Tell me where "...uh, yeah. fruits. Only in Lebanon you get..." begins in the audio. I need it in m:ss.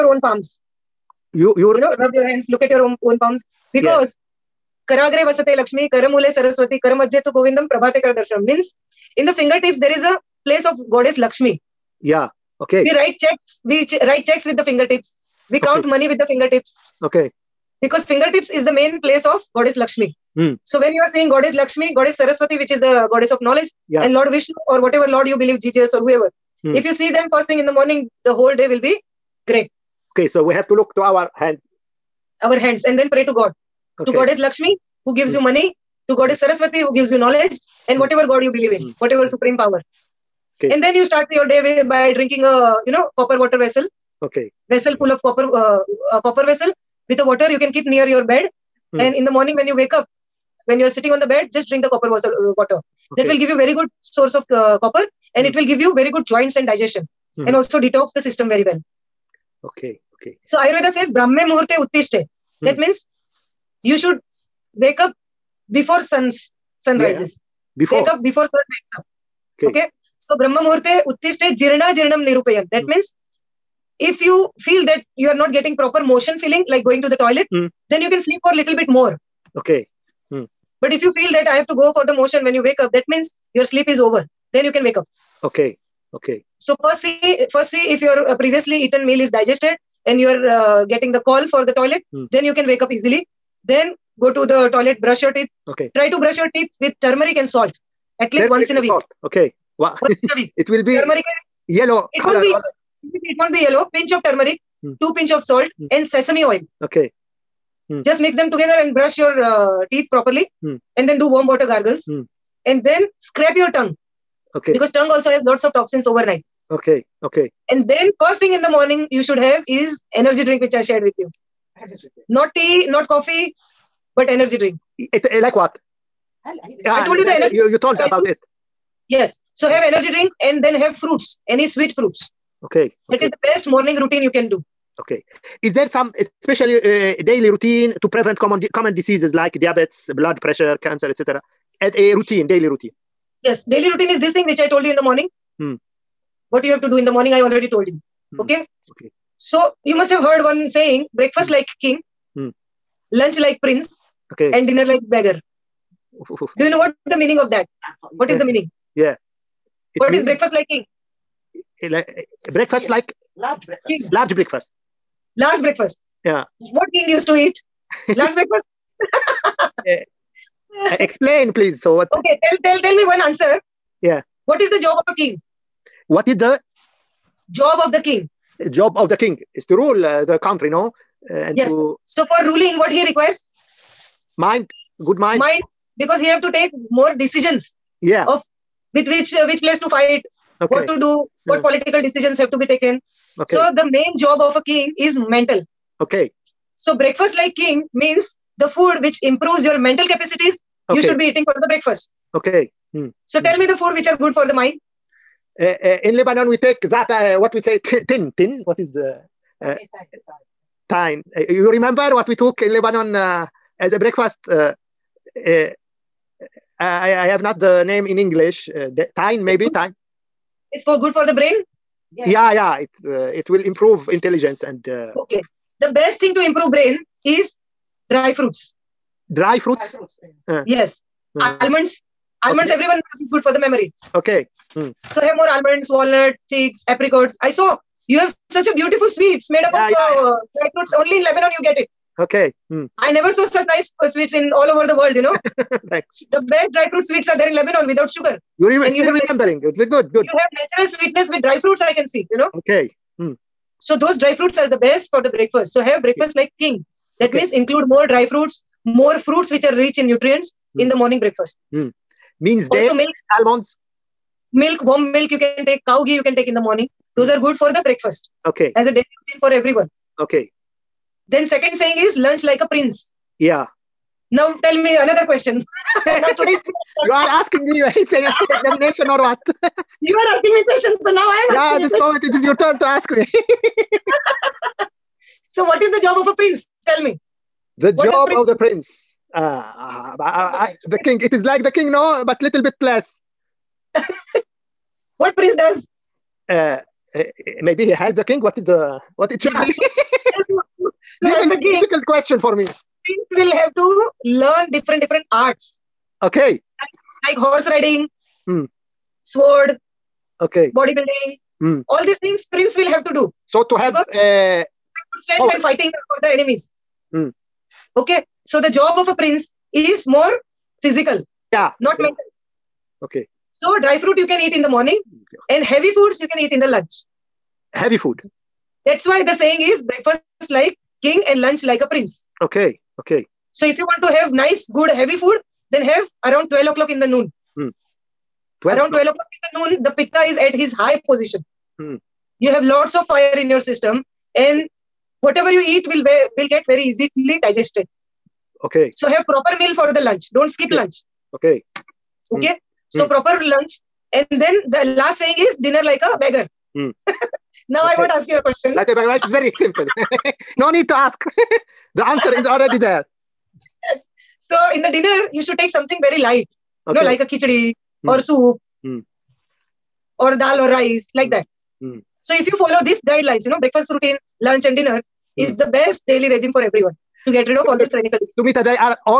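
4:00.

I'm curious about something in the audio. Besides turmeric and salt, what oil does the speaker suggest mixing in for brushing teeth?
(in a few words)
Sesame oil.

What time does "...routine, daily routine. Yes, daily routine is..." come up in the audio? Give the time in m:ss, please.
2:22.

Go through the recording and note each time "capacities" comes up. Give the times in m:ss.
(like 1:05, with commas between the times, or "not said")
3:20.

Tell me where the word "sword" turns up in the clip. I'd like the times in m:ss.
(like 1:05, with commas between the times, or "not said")
5:09.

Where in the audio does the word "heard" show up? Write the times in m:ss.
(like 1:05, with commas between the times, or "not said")
2:30.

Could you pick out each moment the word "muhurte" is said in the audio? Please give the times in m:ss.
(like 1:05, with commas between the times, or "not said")
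1:01, 1:10.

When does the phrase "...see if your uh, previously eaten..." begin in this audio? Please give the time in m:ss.
1:27.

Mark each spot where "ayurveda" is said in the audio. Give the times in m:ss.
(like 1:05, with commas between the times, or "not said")
1:00.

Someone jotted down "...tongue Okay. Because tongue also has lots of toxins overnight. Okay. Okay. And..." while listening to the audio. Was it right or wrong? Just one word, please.
right.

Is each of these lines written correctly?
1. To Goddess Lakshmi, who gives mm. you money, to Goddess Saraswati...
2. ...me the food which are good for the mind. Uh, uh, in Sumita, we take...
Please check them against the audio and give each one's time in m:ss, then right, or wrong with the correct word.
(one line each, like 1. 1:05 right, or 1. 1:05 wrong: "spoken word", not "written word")
1. 0:34 right
2. 3:23 wrong: "Lebanon", not "Sumita".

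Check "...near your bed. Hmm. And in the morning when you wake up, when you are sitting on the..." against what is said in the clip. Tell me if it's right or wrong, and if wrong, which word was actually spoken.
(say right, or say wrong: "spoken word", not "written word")
right.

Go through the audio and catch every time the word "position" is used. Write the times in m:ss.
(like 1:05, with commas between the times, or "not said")
5:41.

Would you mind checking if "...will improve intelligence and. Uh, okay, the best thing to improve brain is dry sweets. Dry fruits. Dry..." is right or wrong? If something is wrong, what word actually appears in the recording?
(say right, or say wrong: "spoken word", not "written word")
wrong: "fruits", not "sweets".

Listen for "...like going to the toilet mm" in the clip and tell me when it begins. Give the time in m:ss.
1:16.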